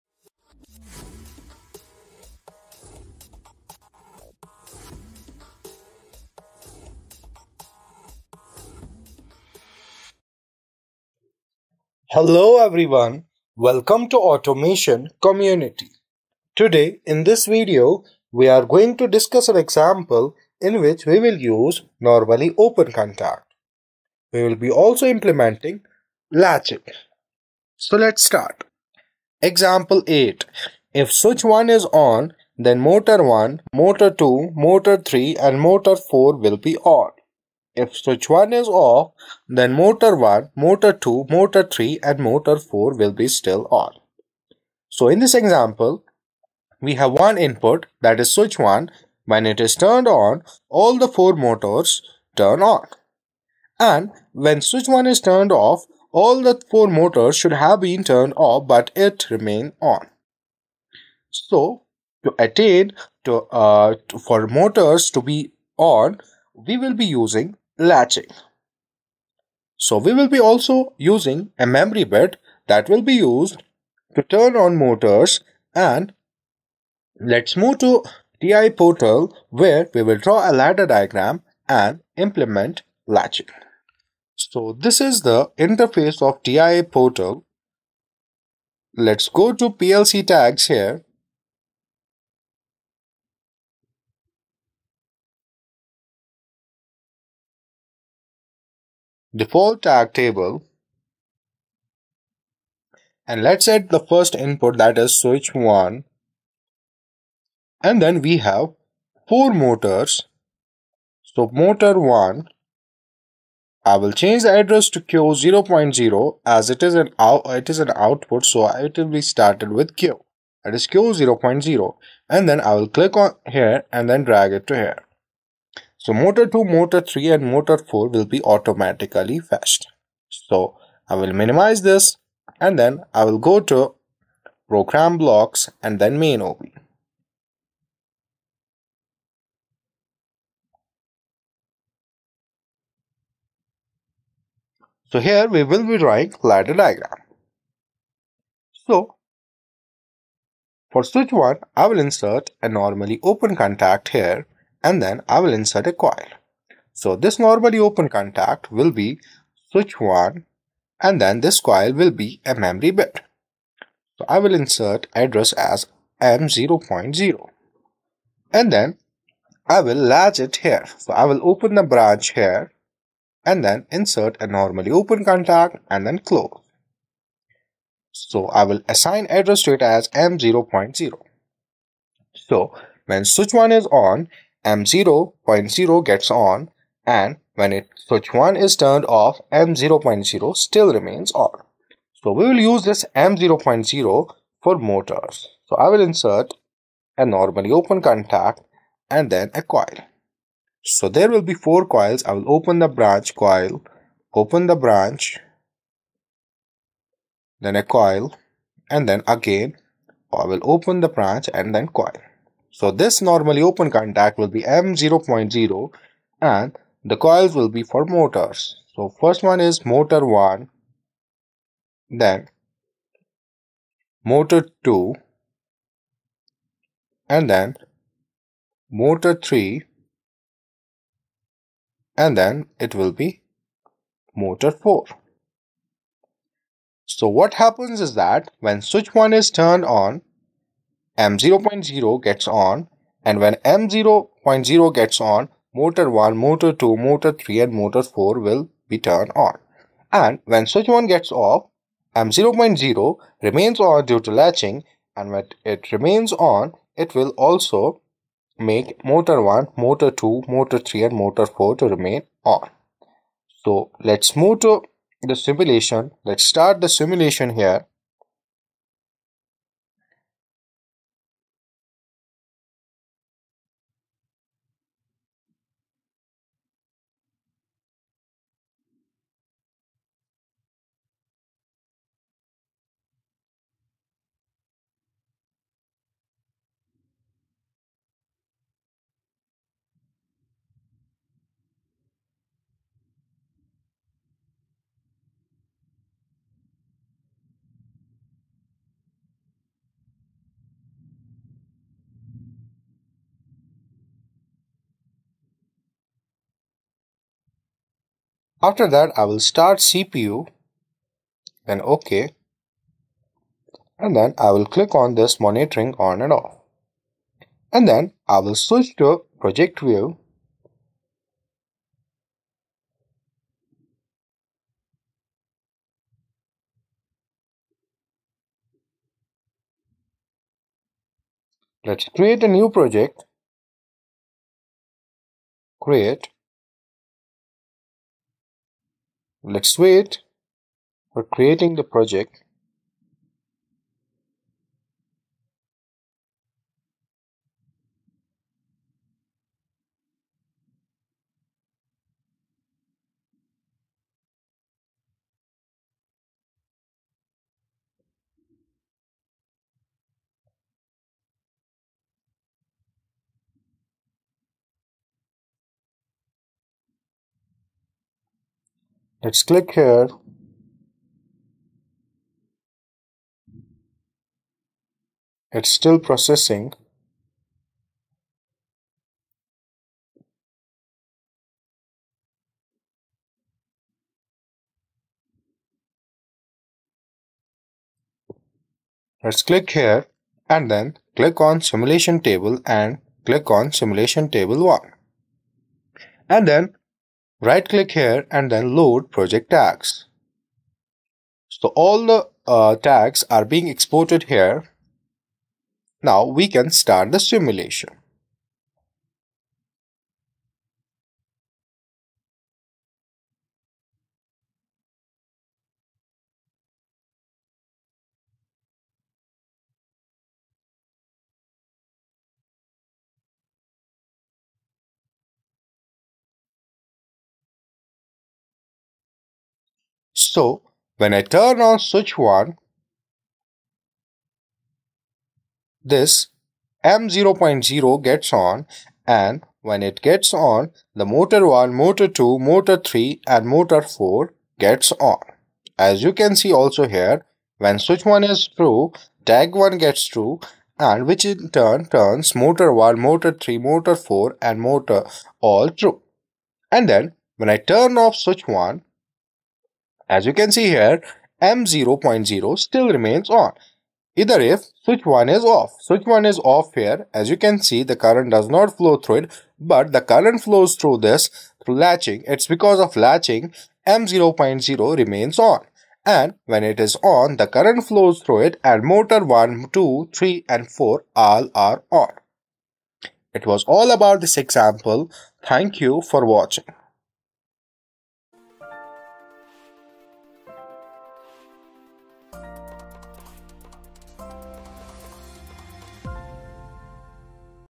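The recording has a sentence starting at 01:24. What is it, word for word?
So this is the interface of TIA portal.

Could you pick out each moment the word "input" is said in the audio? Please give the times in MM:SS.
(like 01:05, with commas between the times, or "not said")
00:47, 01:44.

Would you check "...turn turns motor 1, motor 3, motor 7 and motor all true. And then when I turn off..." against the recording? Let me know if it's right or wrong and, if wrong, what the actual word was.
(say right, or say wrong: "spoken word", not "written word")
wrong: "4", not "7".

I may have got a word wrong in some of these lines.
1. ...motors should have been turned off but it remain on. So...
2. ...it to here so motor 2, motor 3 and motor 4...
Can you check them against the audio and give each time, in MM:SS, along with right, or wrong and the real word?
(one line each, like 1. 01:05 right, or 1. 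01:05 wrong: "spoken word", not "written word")
1. 00:56 right
2. 02:04 right.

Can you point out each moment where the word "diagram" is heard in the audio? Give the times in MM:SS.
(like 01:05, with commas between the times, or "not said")
01:20, 02:26.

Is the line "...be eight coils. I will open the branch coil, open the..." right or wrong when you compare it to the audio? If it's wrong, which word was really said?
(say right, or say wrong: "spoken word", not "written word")
wrong: "four", not "eight".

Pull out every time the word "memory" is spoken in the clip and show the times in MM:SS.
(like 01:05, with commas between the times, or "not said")
01:11, 02:42.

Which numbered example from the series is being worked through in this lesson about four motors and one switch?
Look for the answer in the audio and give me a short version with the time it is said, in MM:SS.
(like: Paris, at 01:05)
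8, at 00:29.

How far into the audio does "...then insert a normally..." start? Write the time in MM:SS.
02:53.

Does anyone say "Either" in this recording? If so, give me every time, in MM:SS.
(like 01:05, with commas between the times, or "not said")
07:44.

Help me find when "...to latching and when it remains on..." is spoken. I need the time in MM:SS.
04:14.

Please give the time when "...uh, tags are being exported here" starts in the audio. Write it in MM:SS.
06:42.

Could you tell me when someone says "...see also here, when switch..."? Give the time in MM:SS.
07:26.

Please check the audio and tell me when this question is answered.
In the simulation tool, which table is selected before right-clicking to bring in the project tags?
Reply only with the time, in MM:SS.
06:33.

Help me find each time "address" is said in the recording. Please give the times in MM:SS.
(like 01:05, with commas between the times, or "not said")
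01:54, 02:45, 02:59.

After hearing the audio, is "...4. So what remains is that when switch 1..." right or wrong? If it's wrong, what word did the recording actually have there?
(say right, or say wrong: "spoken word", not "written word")
wrong: "happens", not "remains".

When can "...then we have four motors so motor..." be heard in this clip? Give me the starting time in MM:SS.
01:48.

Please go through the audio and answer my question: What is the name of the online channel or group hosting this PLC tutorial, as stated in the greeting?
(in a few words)
Automation Community.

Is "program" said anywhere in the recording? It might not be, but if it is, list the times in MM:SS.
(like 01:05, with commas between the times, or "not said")
02:14.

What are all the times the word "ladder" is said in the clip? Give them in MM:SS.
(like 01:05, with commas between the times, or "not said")
01:20, 02:26.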